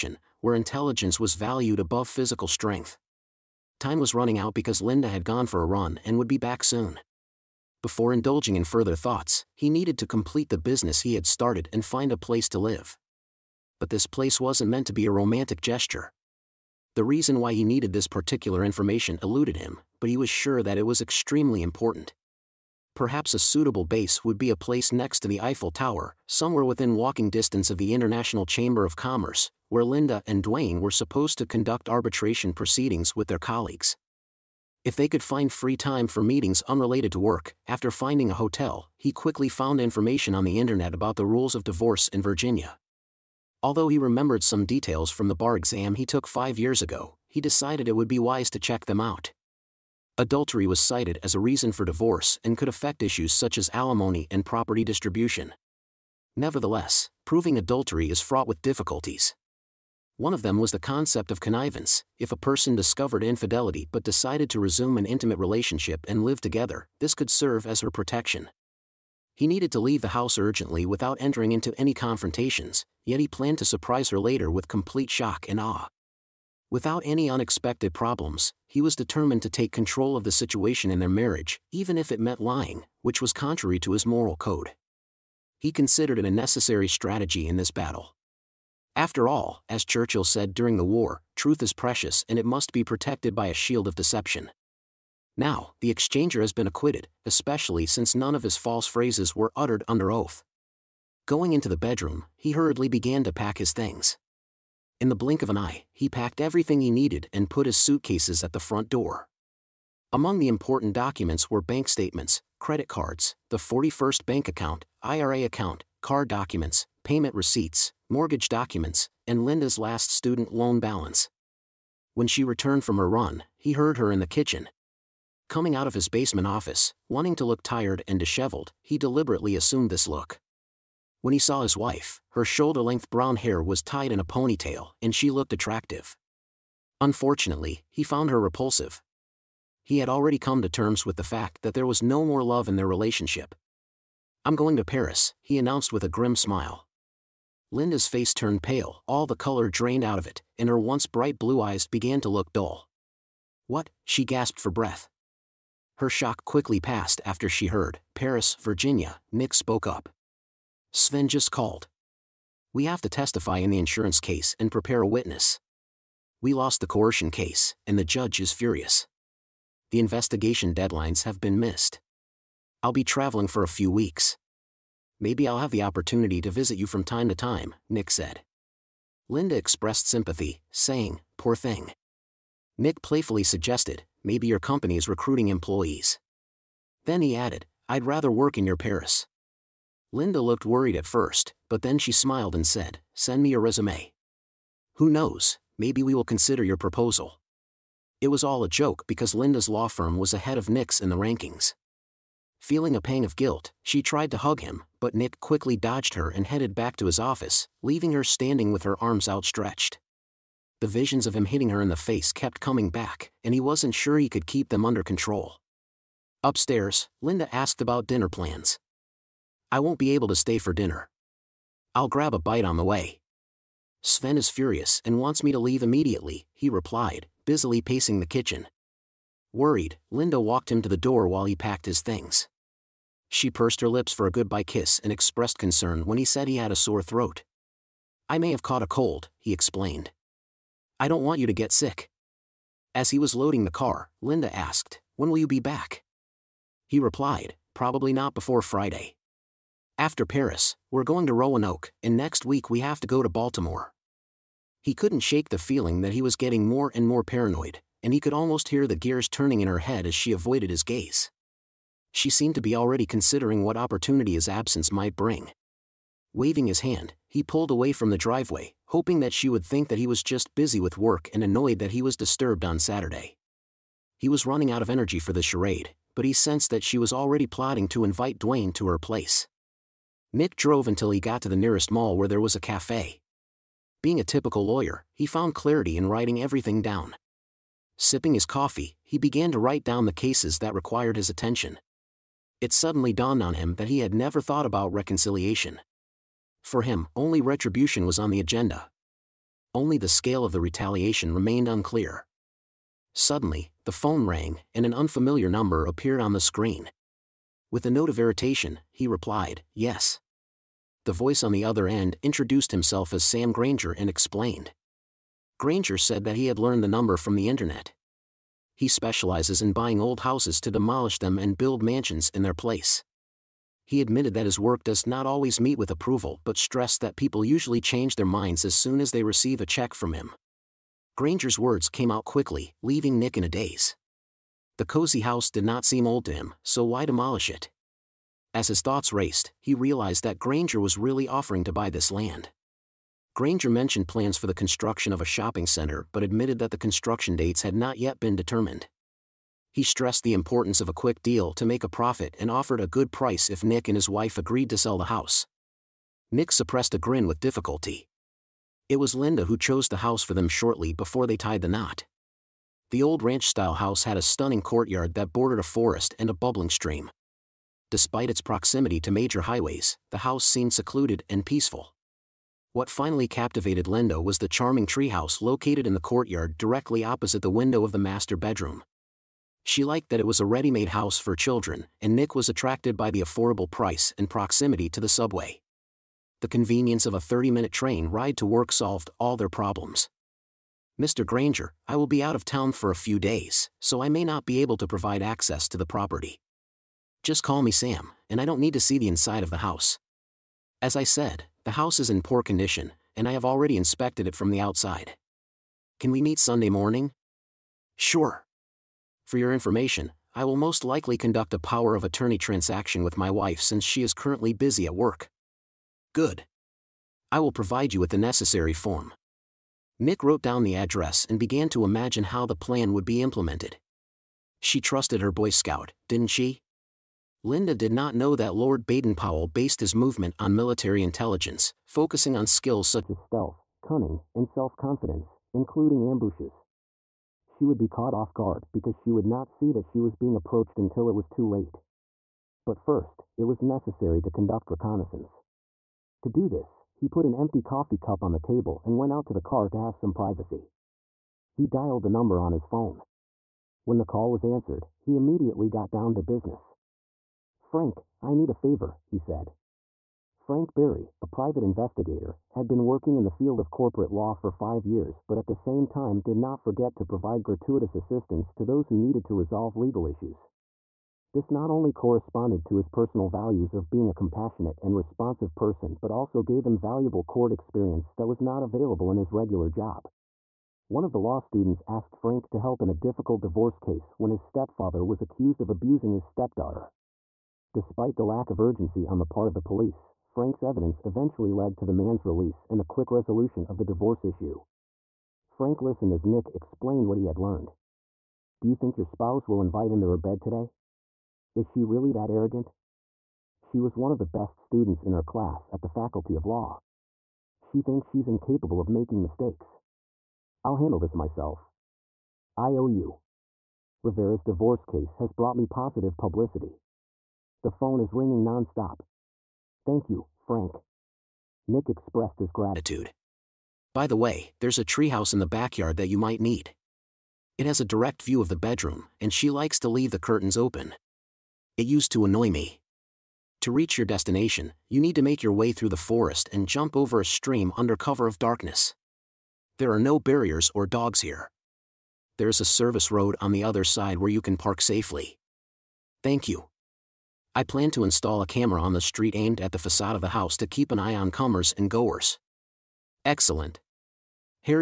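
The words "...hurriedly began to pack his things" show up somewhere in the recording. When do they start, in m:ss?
1:42.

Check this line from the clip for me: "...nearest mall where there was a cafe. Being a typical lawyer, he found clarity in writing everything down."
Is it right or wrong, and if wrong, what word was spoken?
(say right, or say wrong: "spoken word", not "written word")
right.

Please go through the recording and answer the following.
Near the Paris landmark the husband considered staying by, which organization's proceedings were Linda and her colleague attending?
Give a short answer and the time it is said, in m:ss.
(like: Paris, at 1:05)
International Chamber of Commerce, at 0:27.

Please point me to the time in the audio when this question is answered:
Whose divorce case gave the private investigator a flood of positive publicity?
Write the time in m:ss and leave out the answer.
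8:34.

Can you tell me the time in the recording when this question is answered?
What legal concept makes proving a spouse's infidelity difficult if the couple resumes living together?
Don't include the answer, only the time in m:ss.
1:01.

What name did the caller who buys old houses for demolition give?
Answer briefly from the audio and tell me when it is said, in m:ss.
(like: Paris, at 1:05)
Sam Granger, at 5:13.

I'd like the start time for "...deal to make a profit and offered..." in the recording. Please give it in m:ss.
5:51.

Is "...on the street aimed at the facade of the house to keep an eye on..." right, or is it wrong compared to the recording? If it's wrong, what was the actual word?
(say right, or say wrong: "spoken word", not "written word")
right.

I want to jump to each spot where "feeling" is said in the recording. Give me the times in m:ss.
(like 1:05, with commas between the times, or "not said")
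3:22, 4:15.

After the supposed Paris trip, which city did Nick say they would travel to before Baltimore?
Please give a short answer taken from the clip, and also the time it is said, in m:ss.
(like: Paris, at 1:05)
Roanoke, at 4:11.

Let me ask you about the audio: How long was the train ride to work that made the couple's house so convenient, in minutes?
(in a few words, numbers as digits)
30.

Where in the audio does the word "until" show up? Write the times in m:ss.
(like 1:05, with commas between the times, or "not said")
4:40, 7:20.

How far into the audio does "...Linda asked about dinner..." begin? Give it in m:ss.
3:37.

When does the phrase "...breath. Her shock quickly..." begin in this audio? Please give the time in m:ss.
2:34.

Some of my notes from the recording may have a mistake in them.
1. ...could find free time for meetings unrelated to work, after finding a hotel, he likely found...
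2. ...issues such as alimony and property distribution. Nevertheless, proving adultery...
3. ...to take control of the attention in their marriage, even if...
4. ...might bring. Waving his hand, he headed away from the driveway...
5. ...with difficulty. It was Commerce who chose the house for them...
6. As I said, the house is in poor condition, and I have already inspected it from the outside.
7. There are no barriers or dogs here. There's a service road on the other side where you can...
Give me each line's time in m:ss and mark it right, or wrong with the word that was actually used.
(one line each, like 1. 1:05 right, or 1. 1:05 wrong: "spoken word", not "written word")
1. 0:35 wrong: "quickly", not "likely"
2. 0:53 right
3. 1:19 wrong: "situation", not "attention"
4. 4:24 wrong: "pulled", not "headed"
5. 5:57 wrong: "Linda", not "Commerce"
6. 6:40 right
7. 8:59 right.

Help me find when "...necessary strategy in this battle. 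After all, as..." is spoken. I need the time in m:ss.
1:26.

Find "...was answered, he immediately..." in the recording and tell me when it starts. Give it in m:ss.
7:34.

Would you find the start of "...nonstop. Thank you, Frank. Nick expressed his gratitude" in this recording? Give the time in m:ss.
8:38.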